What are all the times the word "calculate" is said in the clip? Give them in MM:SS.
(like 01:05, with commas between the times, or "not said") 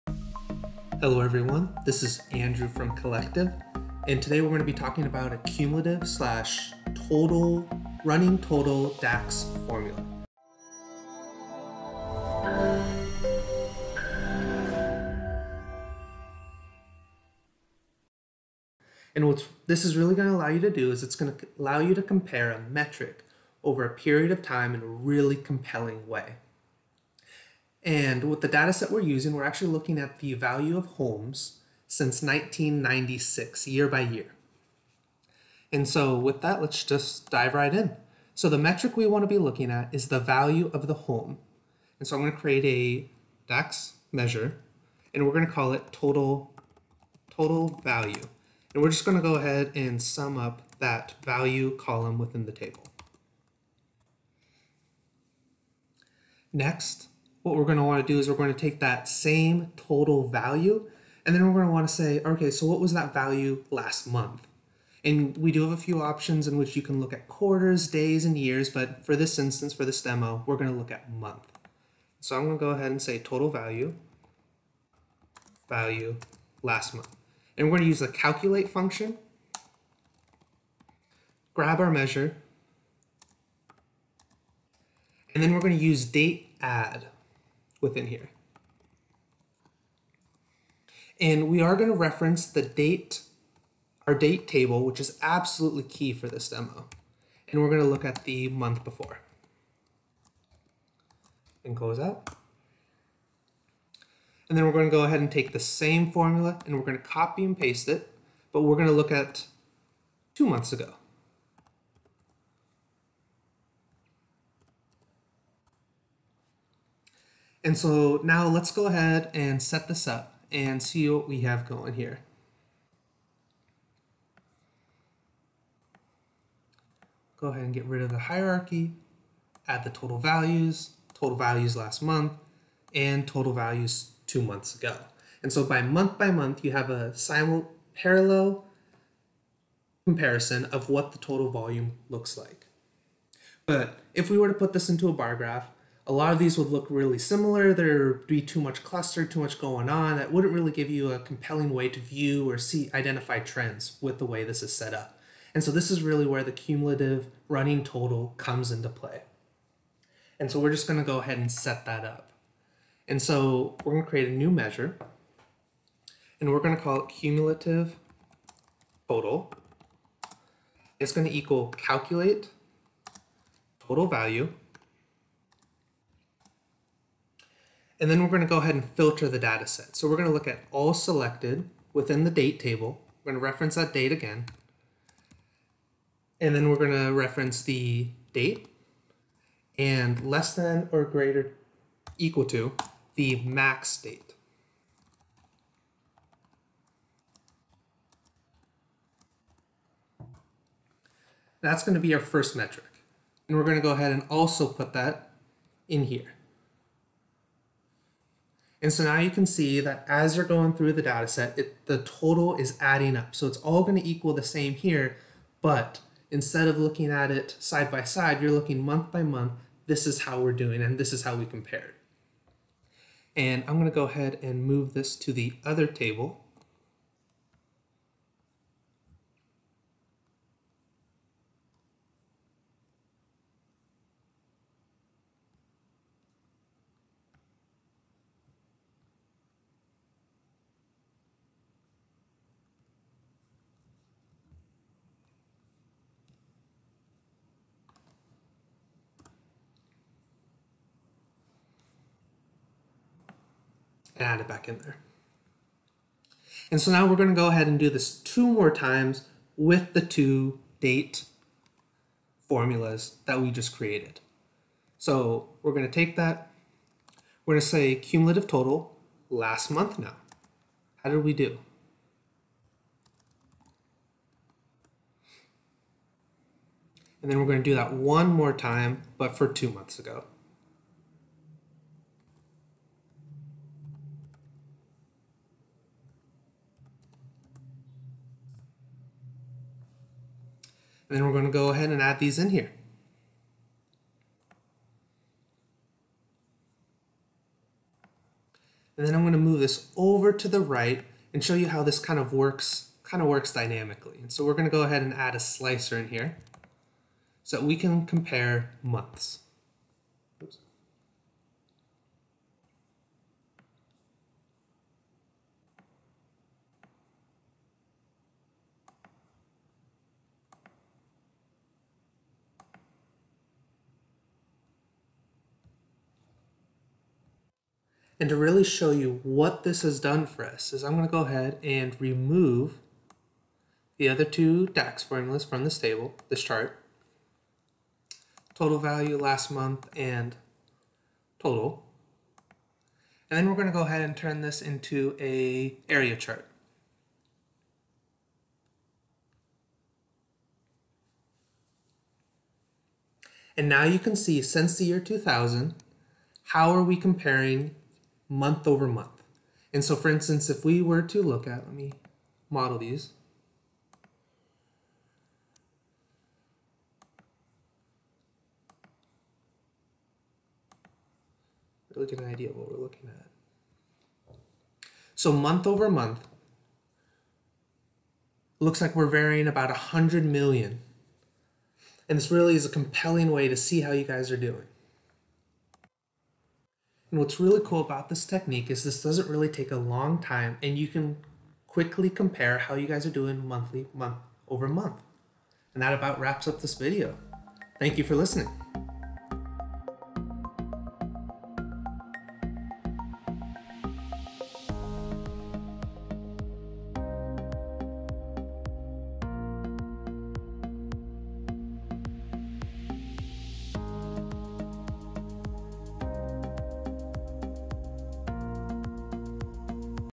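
01:18, 02:51.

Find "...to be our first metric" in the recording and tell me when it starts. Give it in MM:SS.
03:21.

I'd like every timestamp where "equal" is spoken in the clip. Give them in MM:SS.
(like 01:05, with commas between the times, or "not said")
02:51, 03:12, 03:34.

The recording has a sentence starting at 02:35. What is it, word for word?
And so this is really where the cumulative running total comes into play.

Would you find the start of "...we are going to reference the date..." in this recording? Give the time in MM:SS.
01:31.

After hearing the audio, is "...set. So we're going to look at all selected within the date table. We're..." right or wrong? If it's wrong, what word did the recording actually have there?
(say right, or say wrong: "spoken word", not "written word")
right.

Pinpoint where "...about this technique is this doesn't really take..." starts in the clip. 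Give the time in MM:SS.
06:27.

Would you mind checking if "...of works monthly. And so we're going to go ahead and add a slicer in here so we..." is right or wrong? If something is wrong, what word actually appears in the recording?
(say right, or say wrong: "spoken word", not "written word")
wrong: "dynamically", not "monthly".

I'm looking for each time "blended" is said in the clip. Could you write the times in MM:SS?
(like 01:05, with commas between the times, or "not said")
not said.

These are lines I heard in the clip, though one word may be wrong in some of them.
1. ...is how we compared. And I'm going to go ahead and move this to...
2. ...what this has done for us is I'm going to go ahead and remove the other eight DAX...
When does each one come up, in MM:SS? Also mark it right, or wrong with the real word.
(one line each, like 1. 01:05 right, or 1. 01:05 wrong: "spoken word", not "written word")
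1. 03:41 right
2. 05:29 wrong: "two", not "eight".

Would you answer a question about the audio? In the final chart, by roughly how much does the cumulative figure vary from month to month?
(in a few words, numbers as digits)
100 million.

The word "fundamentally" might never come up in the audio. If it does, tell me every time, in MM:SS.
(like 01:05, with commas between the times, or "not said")
not said.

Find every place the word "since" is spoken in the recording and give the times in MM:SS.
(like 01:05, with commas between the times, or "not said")
00:31, 05:54.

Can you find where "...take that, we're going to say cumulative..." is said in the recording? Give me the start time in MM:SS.
04:25.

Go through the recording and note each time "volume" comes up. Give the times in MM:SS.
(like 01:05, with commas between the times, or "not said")
02:21.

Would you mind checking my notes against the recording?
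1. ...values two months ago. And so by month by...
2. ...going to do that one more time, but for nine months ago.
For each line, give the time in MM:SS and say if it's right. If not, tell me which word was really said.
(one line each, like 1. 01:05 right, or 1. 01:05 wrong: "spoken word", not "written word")
1. 02:13 right
2. 04:37 wrong: "two", not "nine".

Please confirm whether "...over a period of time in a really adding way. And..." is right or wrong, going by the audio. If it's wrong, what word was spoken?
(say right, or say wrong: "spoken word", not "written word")
wrong: "compelling", not "adding".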